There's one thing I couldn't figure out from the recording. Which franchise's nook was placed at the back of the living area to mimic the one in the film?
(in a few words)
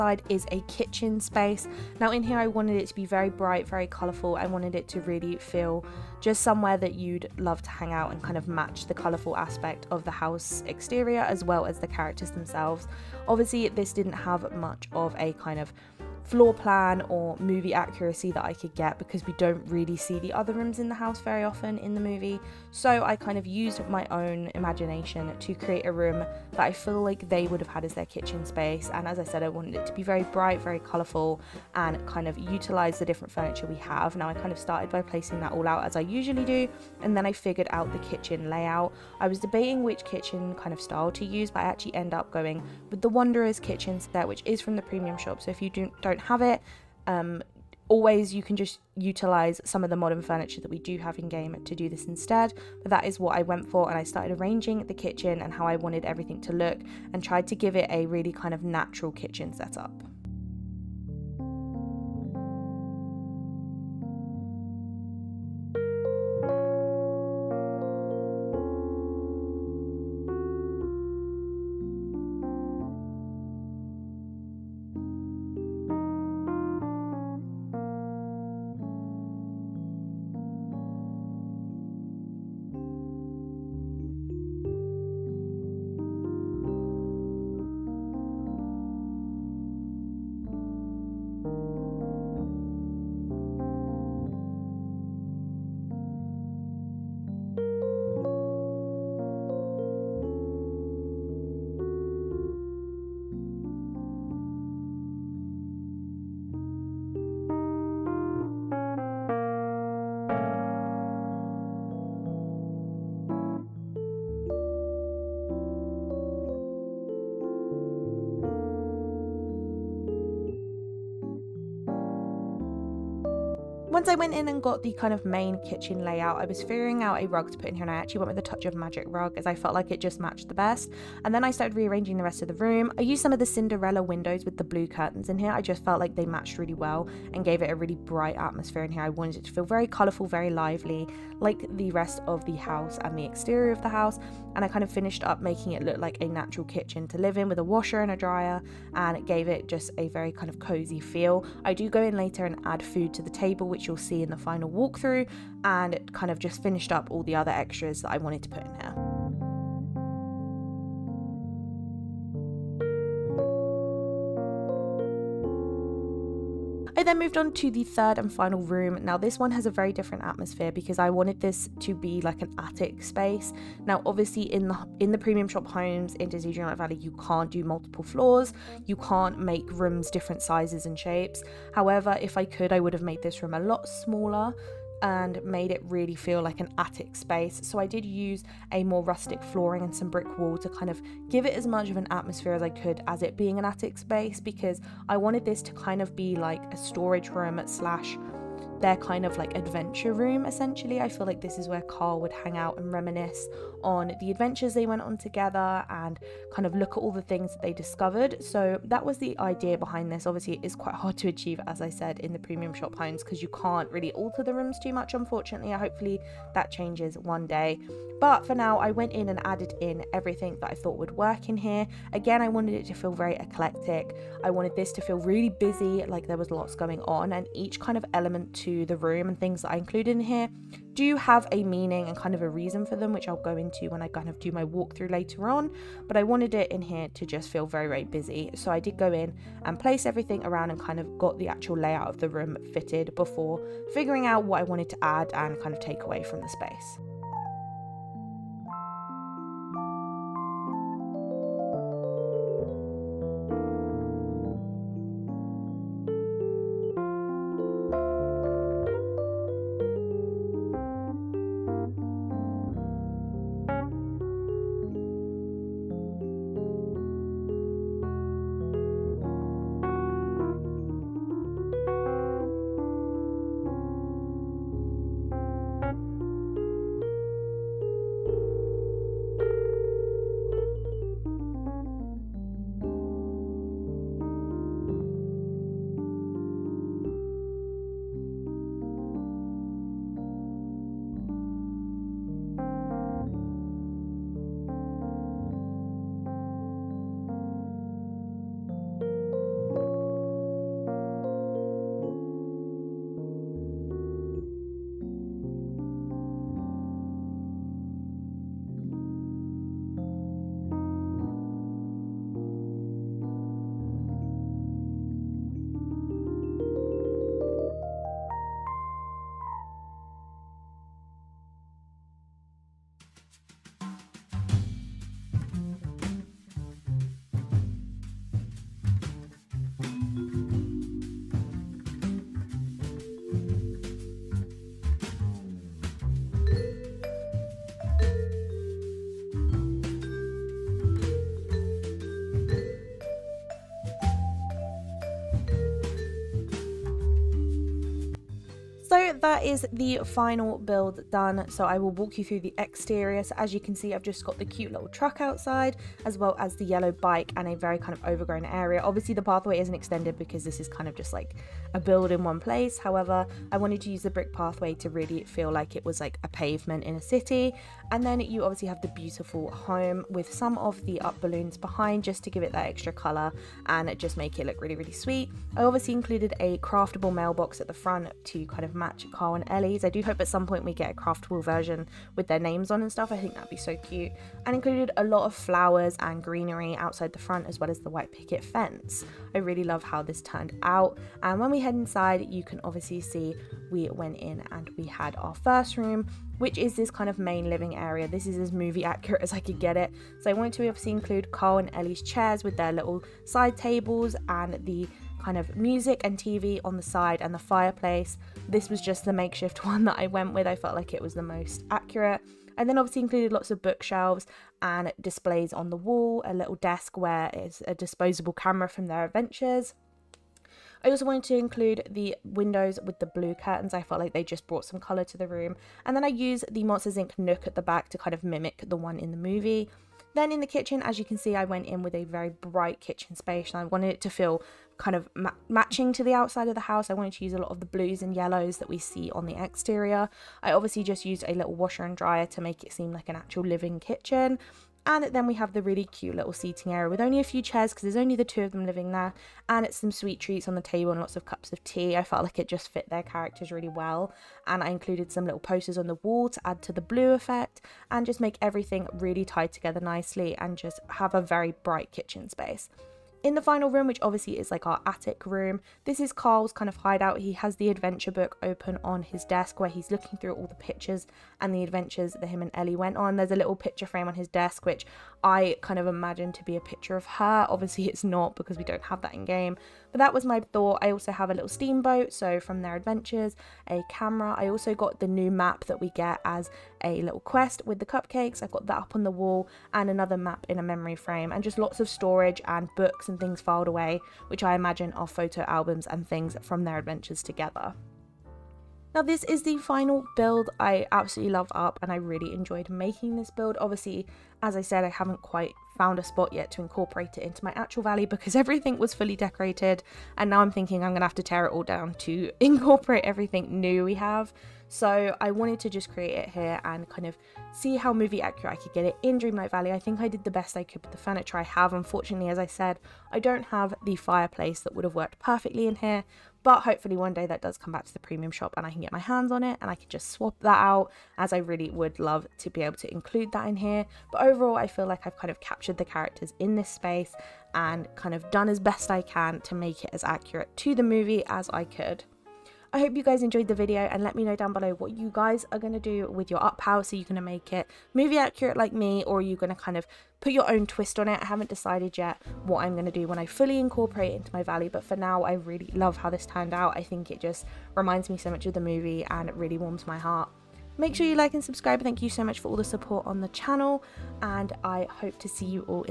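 Monsters Inc.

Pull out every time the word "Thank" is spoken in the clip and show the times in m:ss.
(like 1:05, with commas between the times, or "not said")
9:21.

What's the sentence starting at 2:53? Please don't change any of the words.
Now, obviously, in the in the premium shop homes in Disney Dreamlight Valley, you can't do multiple floors.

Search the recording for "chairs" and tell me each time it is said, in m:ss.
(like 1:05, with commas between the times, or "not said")
6:42, 7:27.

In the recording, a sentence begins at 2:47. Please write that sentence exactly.
then moved on to the third and final room.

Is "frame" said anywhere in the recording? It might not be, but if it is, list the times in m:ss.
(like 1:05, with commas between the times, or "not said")
7:53, 8:10.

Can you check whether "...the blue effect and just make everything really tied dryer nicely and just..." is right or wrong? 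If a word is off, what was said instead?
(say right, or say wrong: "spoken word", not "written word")
wrong: "together", not "dryer".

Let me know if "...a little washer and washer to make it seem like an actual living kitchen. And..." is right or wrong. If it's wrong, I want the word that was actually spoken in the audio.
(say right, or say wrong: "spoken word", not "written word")
wrong: "dryer", not "washer".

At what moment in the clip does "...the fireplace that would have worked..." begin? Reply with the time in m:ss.
8:43.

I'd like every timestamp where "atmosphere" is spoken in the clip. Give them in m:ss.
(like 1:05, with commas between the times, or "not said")
2:18, 2:50, 3:12.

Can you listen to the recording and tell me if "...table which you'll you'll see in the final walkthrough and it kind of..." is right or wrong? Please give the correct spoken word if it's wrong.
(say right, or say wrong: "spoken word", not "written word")
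right.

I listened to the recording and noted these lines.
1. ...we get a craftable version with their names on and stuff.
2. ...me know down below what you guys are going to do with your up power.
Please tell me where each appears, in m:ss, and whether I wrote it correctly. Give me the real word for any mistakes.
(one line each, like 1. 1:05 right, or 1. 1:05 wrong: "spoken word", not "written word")
1. 6:20 right
2. 9:04 right.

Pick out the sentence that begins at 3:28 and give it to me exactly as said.
So that was the idea behind this.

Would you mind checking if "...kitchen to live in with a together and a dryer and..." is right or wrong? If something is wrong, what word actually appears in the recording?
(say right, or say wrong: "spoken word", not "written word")
wrong: "washer", not "together".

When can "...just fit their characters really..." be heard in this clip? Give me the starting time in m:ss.
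7:32.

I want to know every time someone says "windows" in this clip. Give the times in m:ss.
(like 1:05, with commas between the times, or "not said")
2:14, 7:02.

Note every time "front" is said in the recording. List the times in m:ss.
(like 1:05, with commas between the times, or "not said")
6:17, 6:27.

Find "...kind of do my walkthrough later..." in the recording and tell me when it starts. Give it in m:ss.
3:54.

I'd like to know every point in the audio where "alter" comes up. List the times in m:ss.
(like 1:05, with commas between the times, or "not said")
3:34.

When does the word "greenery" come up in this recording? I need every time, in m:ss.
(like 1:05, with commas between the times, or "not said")
6:26.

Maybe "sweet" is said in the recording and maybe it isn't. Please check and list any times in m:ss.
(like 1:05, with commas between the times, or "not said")
6:15, 7:29.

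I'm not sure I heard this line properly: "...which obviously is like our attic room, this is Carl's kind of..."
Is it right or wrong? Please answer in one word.
right.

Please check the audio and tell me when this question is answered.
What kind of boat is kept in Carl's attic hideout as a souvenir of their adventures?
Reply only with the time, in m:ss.
8:01.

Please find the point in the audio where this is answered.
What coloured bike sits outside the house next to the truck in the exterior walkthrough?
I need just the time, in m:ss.
5:56.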